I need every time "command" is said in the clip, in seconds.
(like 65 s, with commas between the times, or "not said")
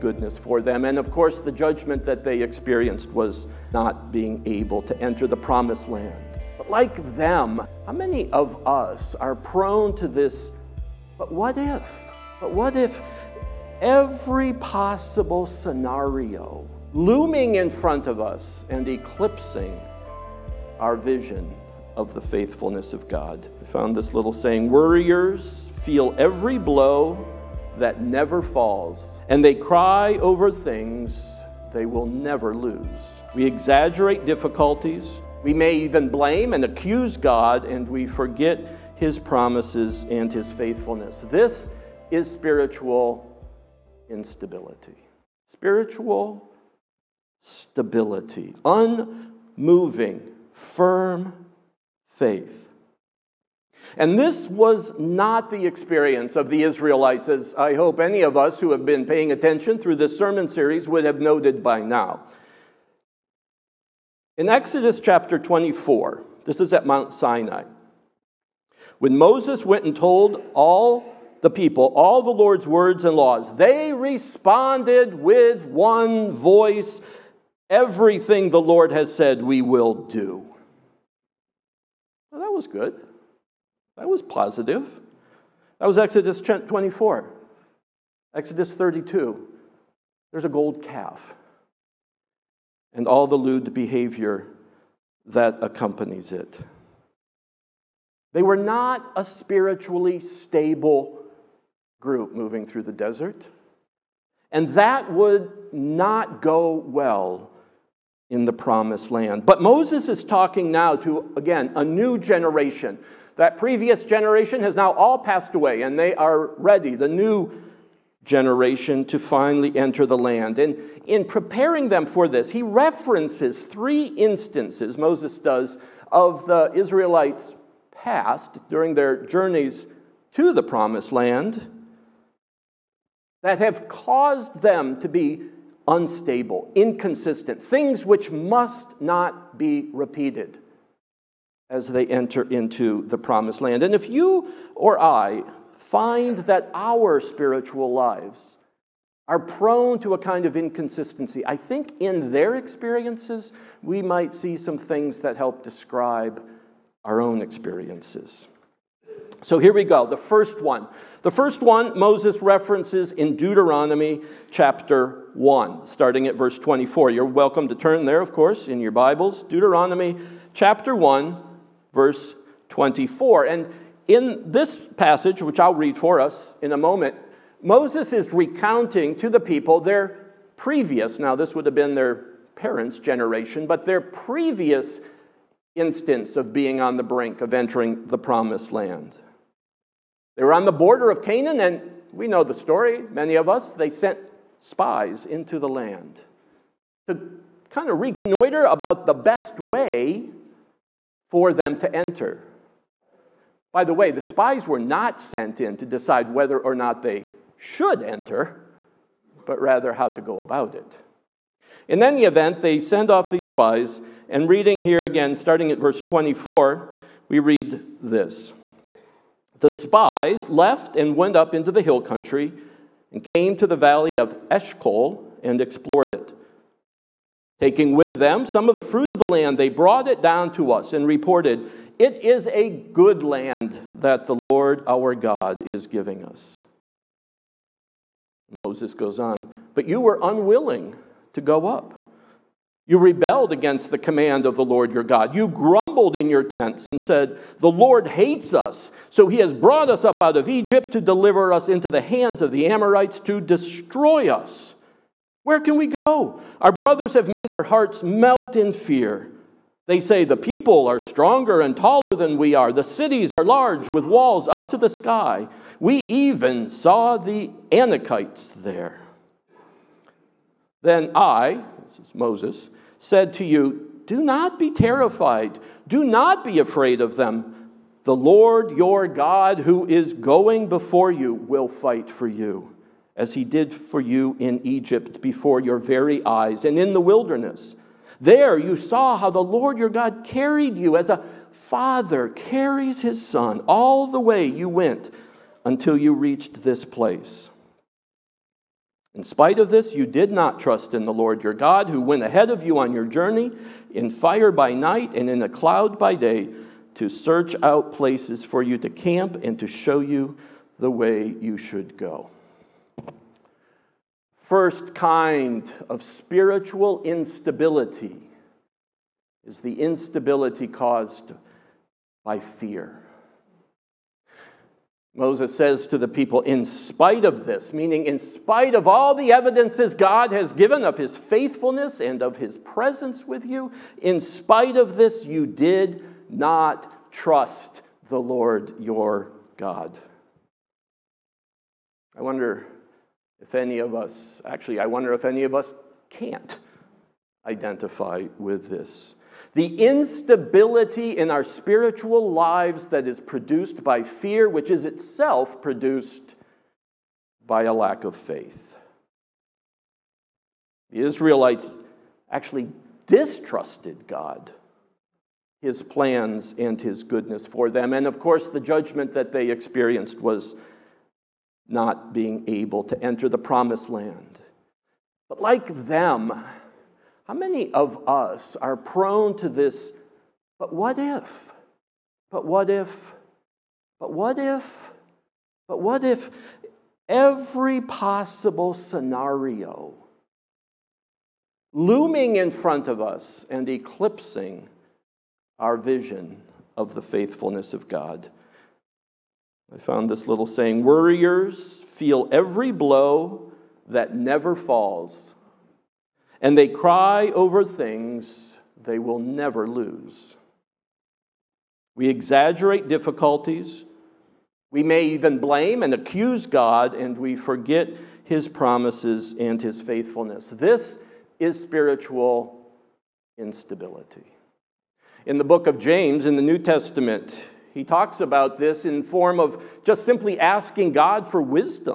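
243 s.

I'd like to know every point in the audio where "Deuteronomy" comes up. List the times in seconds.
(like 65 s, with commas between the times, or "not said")
163 s, 169 s.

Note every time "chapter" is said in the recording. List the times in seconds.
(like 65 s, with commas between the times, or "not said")
64 s, 164 s, 170 s.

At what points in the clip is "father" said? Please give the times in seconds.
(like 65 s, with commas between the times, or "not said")
291 s.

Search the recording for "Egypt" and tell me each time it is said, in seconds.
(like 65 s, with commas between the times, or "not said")
250 s, 284 s.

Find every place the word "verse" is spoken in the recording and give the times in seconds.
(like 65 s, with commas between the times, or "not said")
166 s, 171 s, 215 s.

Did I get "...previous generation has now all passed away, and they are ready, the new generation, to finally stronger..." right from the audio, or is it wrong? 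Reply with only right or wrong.
wrong.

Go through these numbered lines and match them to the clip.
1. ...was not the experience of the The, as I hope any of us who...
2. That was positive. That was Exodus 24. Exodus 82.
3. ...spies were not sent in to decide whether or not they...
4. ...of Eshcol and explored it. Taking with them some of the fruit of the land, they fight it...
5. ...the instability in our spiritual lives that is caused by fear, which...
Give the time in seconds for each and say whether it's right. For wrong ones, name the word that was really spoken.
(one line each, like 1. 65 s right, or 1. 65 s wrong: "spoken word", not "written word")
1. 54 s wrong: "Israelites", not "The"
2. 83 s wrong: "32", not "82"
3. 204 s right
4. 224 s wrong: "brought", not "fight"
5. 349 s wrong: "produced", not "caused".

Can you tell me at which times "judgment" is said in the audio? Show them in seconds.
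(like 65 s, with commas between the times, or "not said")
1 s, 368 s.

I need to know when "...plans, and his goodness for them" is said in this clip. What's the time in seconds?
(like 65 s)
365 s.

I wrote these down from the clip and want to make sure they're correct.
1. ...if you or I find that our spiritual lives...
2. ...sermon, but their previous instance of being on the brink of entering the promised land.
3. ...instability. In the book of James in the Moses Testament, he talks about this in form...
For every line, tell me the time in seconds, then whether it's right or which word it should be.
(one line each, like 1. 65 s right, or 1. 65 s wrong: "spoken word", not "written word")
1. 143 s right
2. 182 s wrong: "generation", not "sermon"
3. 423 s wrong: "New", not "Moses".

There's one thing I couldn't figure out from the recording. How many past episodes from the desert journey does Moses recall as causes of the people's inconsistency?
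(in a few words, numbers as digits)
3.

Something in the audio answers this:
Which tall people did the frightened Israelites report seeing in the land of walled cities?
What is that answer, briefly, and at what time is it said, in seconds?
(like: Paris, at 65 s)
the Anakites, at 267 s.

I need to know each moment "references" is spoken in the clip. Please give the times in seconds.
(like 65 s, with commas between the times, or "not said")
122 s, 162 s.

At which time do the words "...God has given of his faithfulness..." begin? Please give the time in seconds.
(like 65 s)
329 s.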